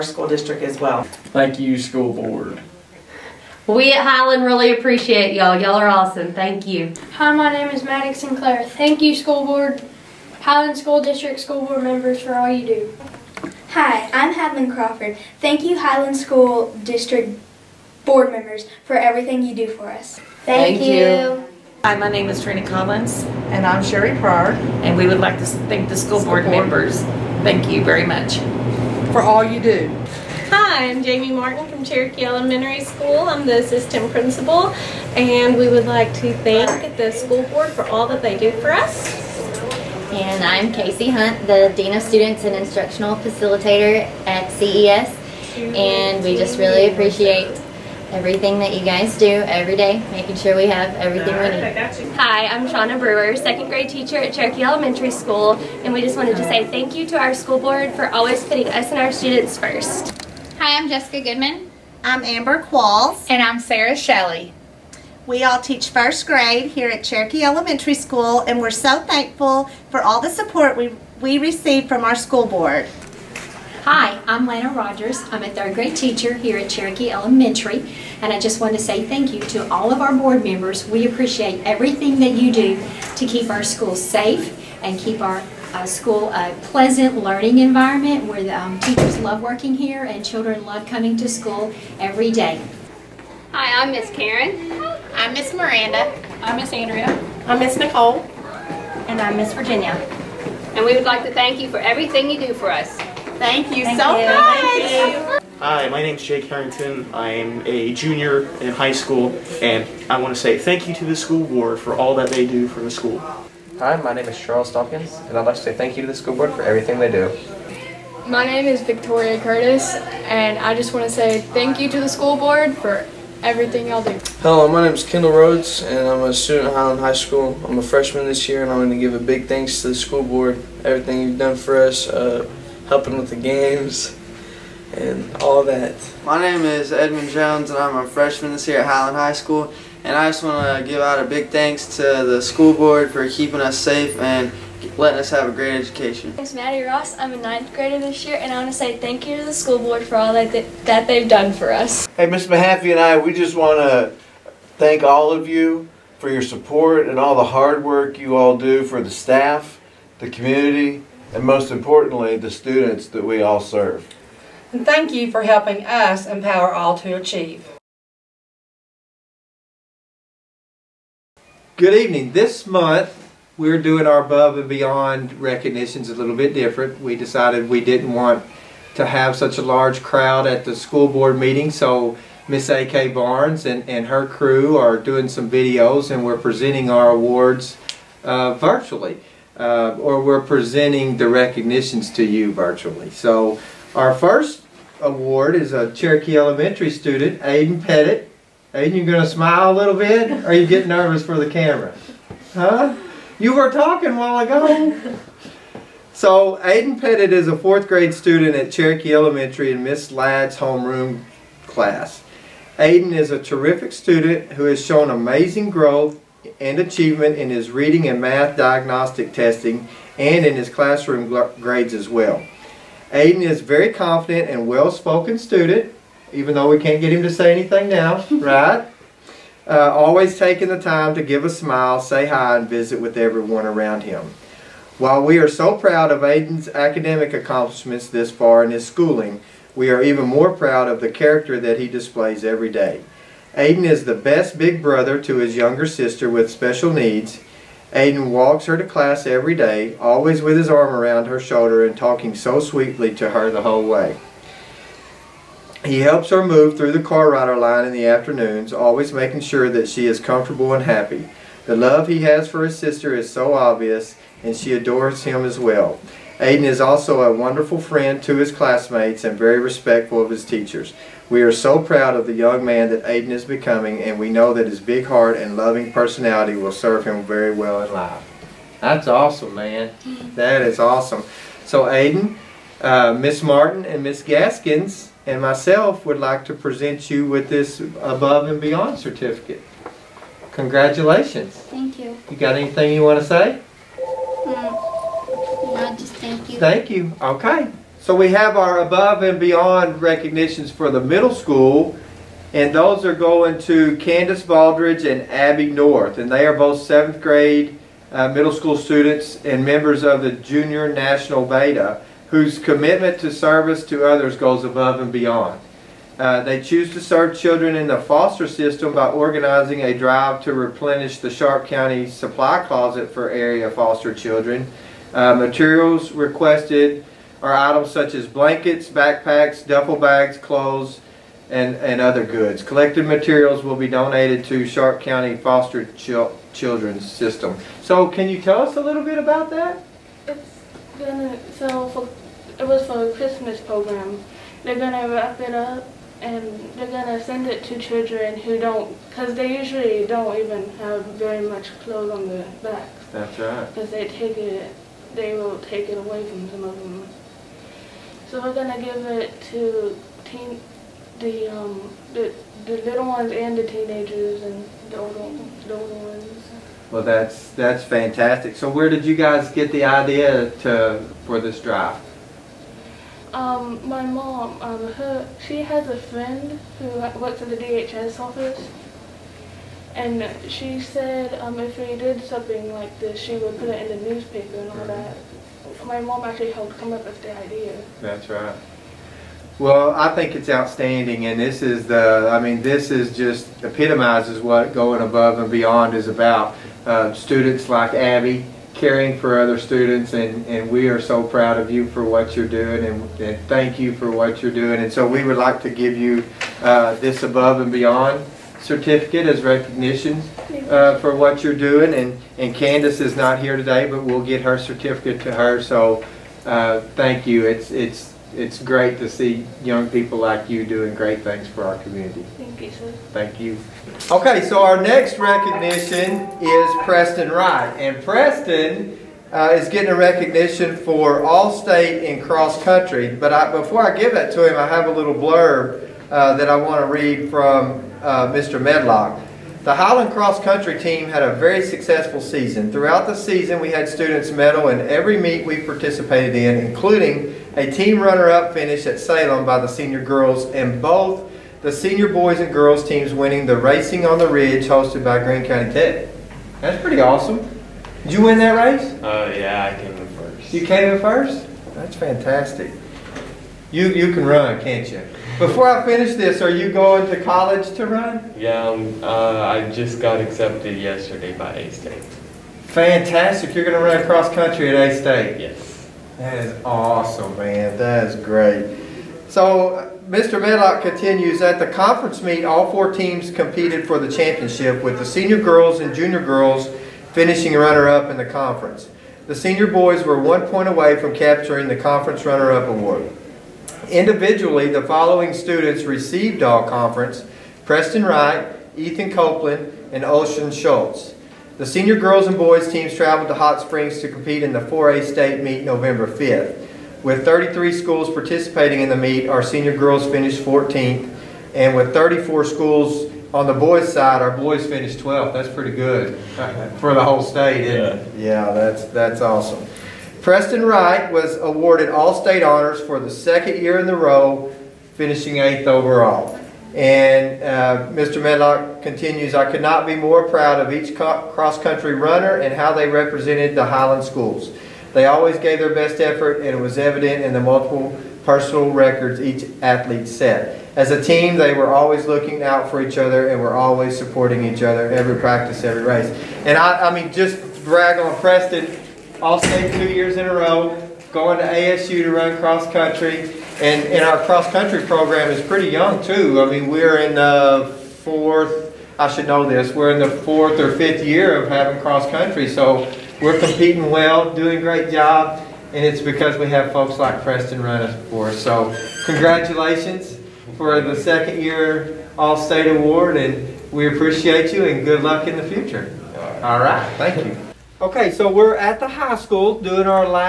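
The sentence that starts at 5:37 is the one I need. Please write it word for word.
So can you tell us a little bit about that?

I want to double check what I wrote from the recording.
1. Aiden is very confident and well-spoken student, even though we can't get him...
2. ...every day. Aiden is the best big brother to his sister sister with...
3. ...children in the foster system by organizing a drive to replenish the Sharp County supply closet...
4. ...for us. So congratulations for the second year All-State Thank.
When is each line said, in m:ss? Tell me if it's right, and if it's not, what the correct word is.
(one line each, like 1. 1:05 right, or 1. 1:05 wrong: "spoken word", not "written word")
1. 3:43 right
2. 4:02 wrong: "younger", not "sister"
3. 5:17 right
4. 9:28 wrong: "Award", not "Thank".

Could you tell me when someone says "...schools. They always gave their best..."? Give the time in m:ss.
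8:54.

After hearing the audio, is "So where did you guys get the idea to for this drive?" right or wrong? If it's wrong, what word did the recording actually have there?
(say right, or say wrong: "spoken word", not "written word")
right.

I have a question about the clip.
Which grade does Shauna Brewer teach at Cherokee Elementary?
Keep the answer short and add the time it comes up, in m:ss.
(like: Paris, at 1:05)
Second grade, at 0:53.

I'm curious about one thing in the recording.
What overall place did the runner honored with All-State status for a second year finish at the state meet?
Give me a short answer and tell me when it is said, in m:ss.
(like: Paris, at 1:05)
8th, at 8:45.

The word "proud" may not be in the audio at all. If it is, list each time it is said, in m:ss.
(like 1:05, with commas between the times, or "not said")
3:55, 4:00, 4:31, 6:41, 8:50.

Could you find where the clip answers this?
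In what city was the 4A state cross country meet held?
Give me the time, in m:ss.
8:23.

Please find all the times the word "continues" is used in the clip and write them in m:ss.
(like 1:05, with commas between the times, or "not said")
8:00, 8:48.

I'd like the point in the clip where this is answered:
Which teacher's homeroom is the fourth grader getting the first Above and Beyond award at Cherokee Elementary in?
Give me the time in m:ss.
3:29.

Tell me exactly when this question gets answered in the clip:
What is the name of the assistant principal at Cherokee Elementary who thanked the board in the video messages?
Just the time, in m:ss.
0:31.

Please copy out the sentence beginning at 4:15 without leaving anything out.
He helps her move through the car rider line in the afternoons, always making sure that she is comfortable and happy.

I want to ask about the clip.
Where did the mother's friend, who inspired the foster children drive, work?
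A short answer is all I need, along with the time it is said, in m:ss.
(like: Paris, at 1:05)
DHS office, at 6:17.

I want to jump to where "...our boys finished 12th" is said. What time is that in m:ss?
8:34.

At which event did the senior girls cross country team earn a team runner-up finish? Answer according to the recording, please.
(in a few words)
Salem.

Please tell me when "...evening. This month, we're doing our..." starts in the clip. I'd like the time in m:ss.
2:51.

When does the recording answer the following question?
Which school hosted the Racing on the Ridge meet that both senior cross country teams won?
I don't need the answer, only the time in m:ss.
7:35.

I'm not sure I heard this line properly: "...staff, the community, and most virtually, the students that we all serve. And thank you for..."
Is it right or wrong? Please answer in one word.
wrong.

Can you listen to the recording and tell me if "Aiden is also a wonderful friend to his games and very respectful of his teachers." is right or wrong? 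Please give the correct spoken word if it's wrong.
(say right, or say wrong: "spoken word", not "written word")
wrong: "classmates", not "games".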